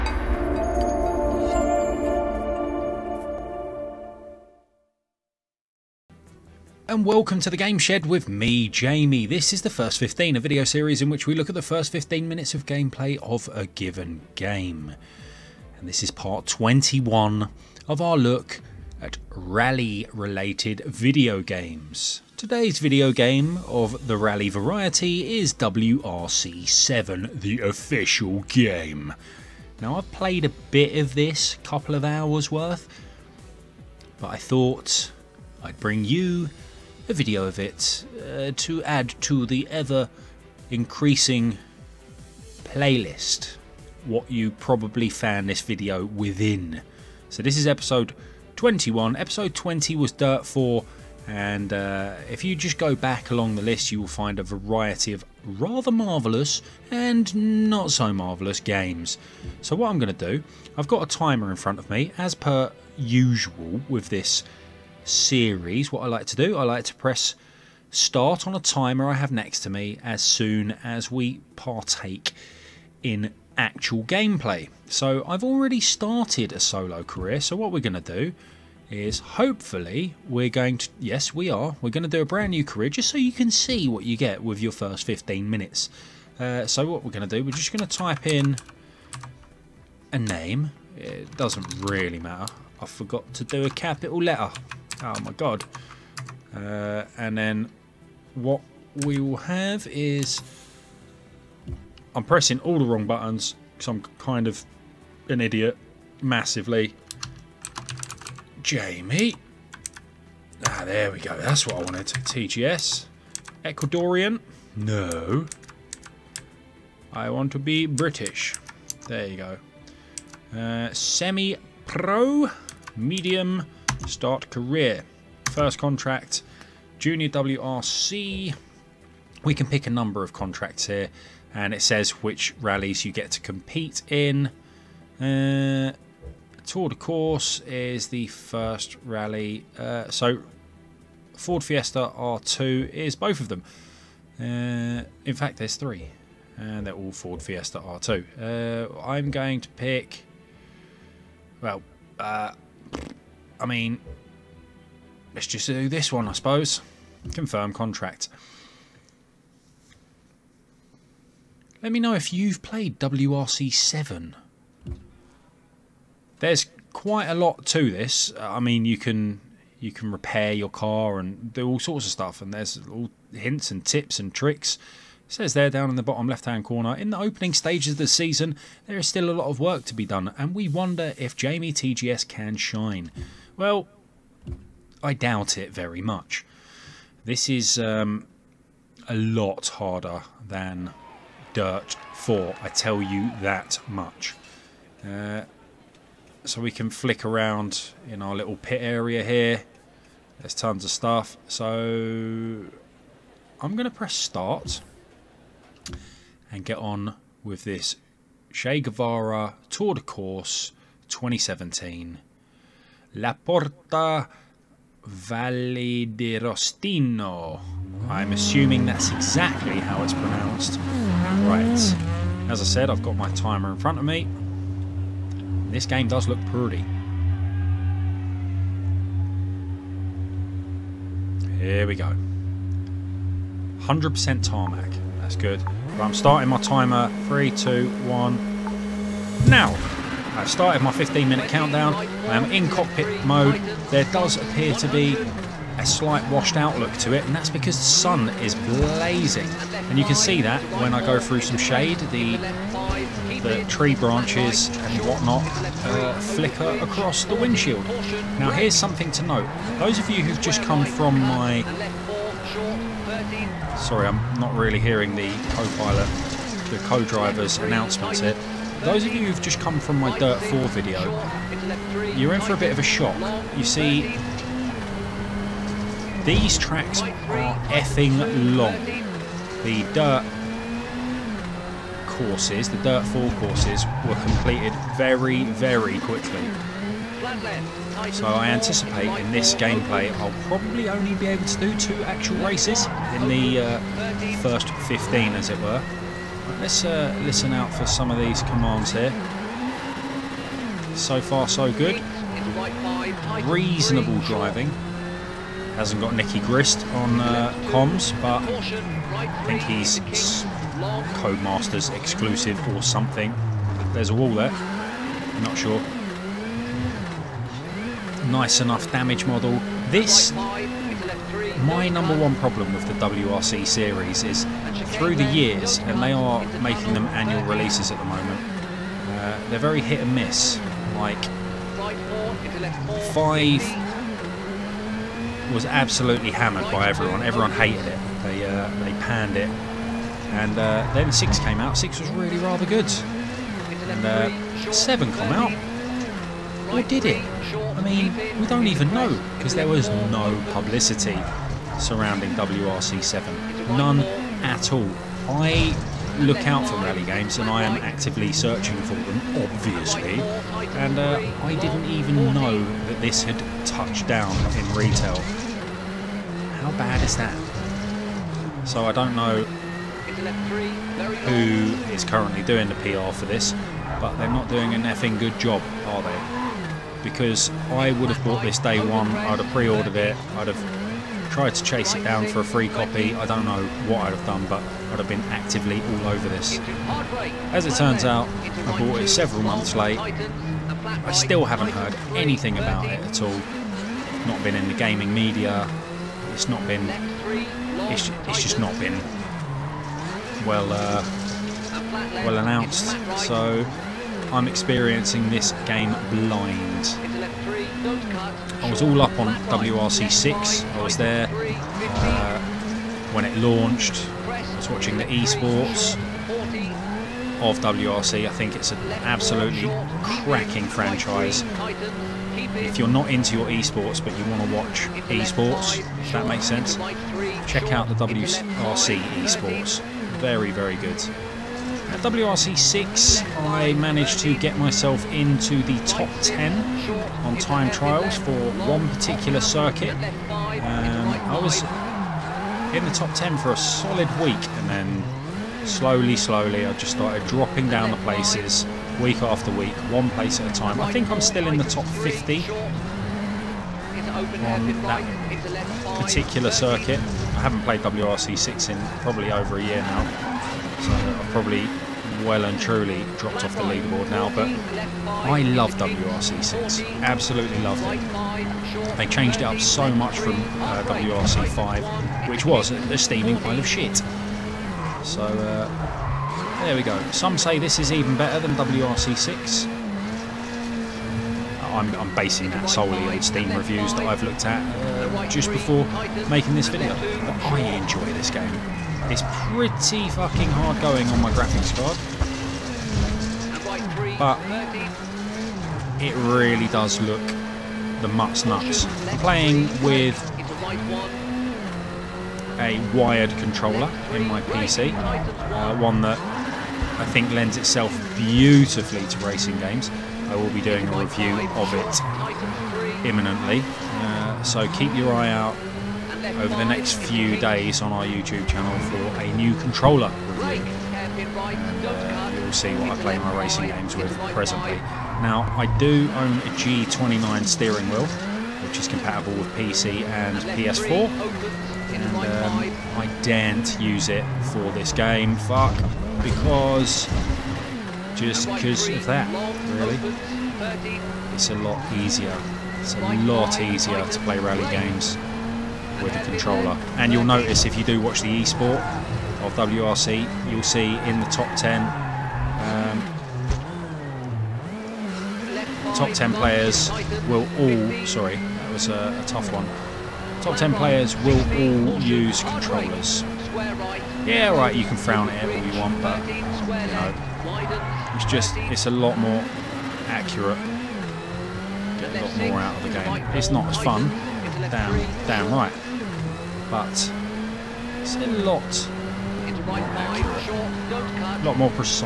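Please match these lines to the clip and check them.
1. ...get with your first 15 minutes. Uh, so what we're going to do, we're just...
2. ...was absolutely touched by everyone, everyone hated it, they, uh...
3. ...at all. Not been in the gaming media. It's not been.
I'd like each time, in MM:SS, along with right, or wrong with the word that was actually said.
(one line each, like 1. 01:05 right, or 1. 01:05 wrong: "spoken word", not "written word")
1. 01:24 right
2. 05:35 wrong: "hammered", not "touched"
3. 06:32 right.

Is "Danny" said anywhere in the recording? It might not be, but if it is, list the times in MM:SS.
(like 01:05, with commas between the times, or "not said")
not said.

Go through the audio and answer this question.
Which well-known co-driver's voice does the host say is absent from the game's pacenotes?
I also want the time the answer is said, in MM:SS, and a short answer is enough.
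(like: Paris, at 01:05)
Nicky Grist, at 05:06.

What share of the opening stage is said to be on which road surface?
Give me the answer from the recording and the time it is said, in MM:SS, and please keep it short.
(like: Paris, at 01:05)
100% tarmac, at 03:53.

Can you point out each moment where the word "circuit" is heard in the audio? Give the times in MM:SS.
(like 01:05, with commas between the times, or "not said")
07:19, 07:36.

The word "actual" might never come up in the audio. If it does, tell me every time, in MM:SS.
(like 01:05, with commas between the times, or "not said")
01:13, 04:52.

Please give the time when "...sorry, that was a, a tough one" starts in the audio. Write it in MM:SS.
09:18.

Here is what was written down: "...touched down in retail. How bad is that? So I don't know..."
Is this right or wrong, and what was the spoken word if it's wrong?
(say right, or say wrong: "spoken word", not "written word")
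right.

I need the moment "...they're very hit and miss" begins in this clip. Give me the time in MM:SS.
05:29.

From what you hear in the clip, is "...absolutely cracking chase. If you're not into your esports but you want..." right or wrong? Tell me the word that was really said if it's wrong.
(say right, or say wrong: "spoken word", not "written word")
wrong: "franchise", not "chase".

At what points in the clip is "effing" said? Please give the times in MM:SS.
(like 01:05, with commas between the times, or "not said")
04:37, 06:14.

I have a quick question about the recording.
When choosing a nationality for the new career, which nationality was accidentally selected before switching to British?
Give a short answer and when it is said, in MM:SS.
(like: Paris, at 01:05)
Ecuadorian, at 01:53.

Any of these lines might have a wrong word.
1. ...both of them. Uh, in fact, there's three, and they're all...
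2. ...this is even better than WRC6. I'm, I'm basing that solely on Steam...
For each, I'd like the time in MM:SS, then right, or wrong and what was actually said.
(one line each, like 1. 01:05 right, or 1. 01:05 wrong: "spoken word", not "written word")
1. 02:23 right
2. 07:57 right.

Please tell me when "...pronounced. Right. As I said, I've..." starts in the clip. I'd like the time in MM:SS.
03:40.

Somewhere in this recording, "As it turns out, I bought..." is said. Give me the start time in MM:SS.
06:27.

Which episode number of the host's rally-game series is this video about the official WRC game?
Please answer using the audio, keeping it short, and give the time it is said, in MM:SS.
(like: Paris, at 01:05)
21, at 00:16.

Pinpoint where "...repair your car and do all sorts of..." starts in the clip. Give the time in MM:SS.
02:50.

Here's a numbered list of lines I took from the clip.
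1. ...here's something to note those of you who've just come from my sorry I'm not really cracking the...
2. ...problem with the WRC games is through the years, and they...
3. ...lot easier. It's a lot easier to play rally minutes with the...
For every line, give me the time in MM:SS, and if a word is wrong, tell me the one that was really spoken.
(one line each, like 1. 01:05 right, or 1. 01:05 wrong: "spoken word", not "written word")
1. 04:18 wrong: "hearing", not "cracking"
2. 05:22 wrong: "series", not "games"
3. 09:01 wrong: "games", not "minutes".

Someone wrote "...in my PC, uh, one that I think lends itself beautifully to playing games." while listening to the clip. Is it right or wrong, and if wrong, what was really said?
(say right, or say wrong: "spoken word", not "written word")
wrong: "racing", not "playing".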